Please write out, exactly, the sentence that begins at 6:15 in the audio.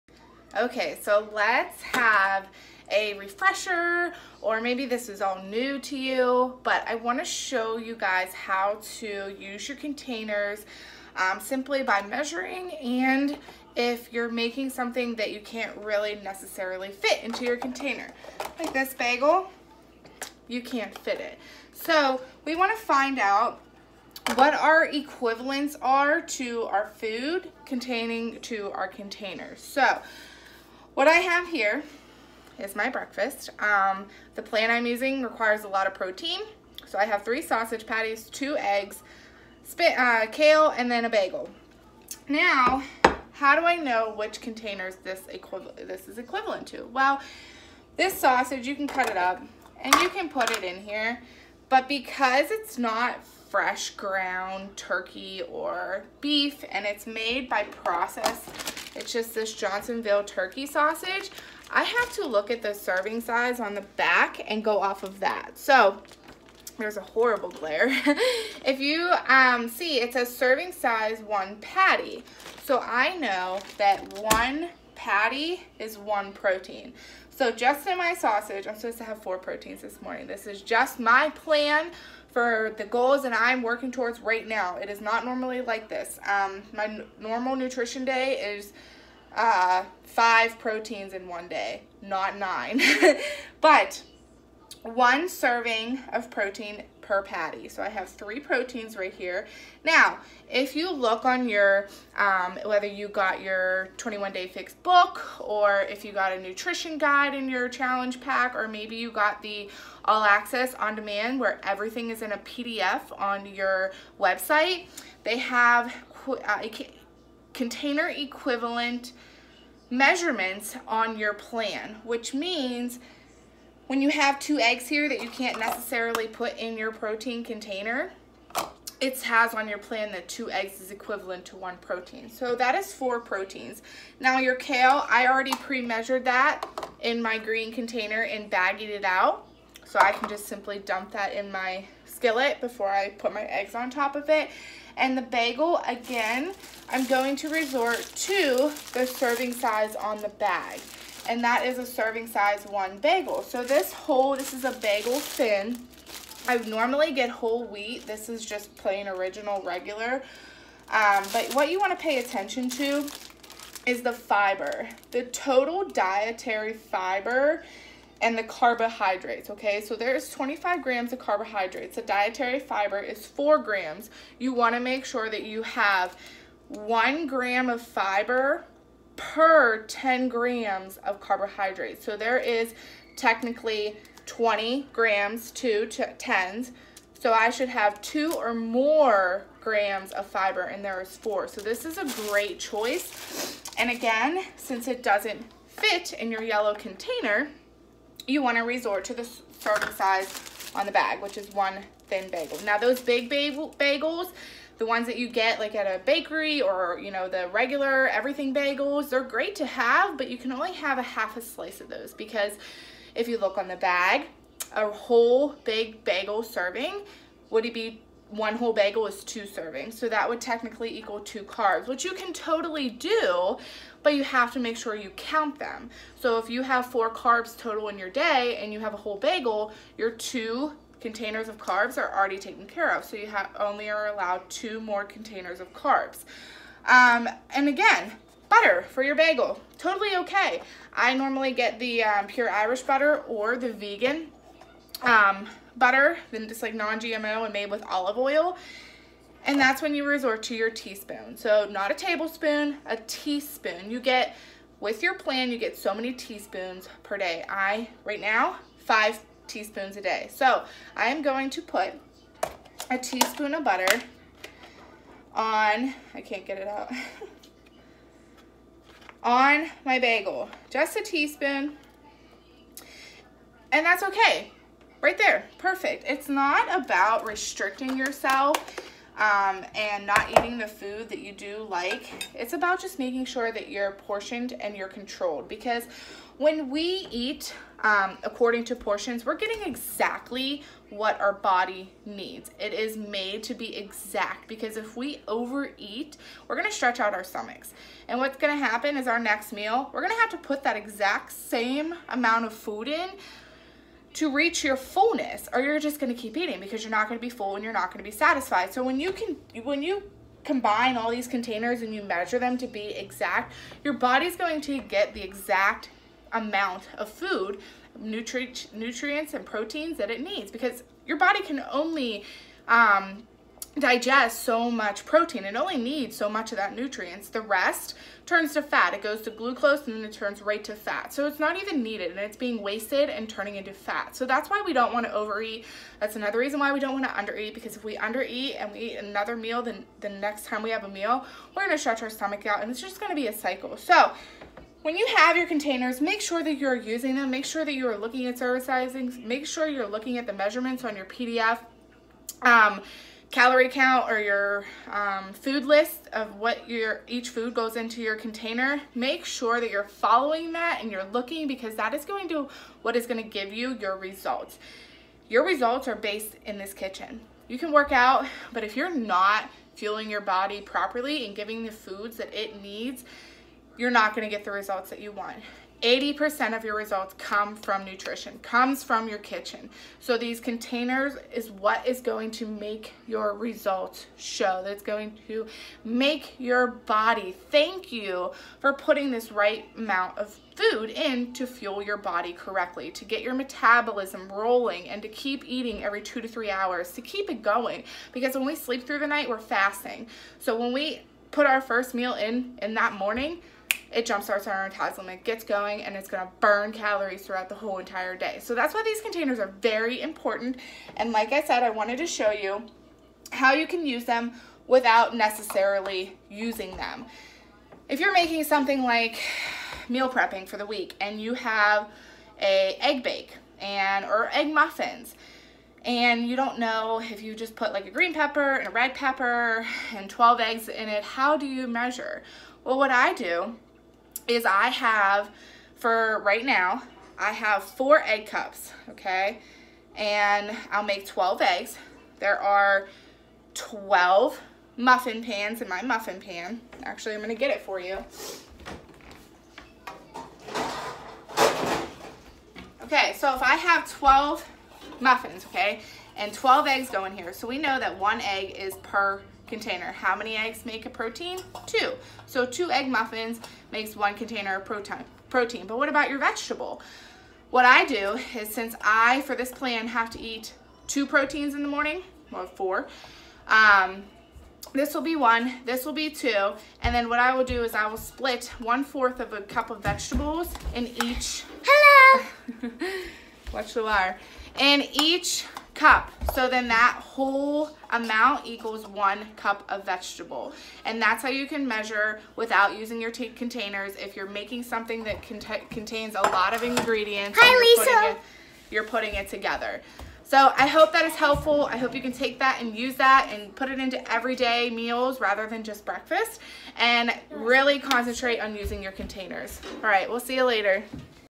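80% of your results come from nutrition, comes from your kitchen.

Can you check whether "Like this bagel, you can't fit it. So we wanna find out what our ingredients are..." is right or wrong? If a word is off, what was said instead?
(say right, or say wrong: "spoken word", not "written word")
wrong: "equivalents", not "ingredients".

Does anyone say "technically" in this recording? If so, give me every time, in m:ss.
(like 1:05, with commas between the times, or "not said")
3:03, 3:40.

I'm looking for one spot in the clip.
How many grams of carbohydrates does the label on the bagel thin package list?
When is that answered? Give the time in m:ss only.
2:50.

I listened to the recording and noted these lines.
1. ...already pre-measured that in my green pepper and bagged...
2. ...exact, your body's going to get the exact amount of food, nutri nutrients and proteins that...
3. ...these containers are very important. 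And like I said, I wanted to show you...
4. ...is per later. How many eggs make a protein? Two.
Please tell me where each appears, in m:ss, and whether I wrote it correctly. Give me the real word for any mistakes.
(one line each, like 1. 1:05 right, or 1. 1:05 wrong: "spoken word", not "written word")
1. 2:15 wrong: "container", not "pepper"
2. 5:12 right
3. 6:48 right
4. 7:38 wrong: "container", not "later".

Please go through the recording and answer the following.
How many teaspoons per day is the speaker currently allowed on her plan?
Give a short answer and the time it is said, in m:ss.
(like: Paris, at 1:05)
5, at 4:18.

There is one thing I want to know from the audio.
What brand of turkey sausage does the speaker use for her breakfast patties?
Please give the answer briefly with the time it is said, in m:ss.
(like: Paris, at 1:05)
Johnsonville, at 0:59.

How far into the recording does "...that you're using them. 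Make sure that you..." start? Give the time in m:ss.
5:46.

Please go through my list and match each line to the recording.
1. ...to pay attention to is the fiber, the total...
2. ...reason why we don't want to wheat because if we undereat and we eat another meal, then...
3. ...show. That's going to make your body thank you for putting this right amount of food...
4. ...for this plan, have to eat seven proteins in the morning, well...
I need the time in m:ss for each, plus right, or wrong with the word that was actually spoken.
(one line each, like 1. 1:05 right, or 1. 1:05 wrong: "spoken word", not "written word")
1. 2:41 right
2. 5:36 wrong: "undereat", not "wheat"
3. 6:24 right
4. 7:49 wrong: "two", not "seven".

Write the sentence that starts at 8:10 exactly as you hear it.
And that's how you can measure without using your containers.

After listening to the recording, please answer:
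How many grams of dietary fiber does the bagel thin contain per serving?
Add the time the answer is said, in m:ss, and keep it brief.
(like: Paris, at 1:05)
4 grams, at 2:53.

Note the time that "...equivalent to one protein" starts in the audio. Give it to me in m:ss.
2:10.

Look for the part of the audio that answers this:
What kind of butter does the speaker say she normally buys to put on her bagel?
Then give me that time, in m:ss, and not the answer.
4:02.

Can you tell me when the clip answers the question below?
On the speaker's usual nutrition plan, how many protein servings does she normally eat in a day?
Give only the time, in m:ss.
1:30.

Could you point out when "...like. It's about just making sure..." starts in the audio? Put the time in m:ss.
4:41.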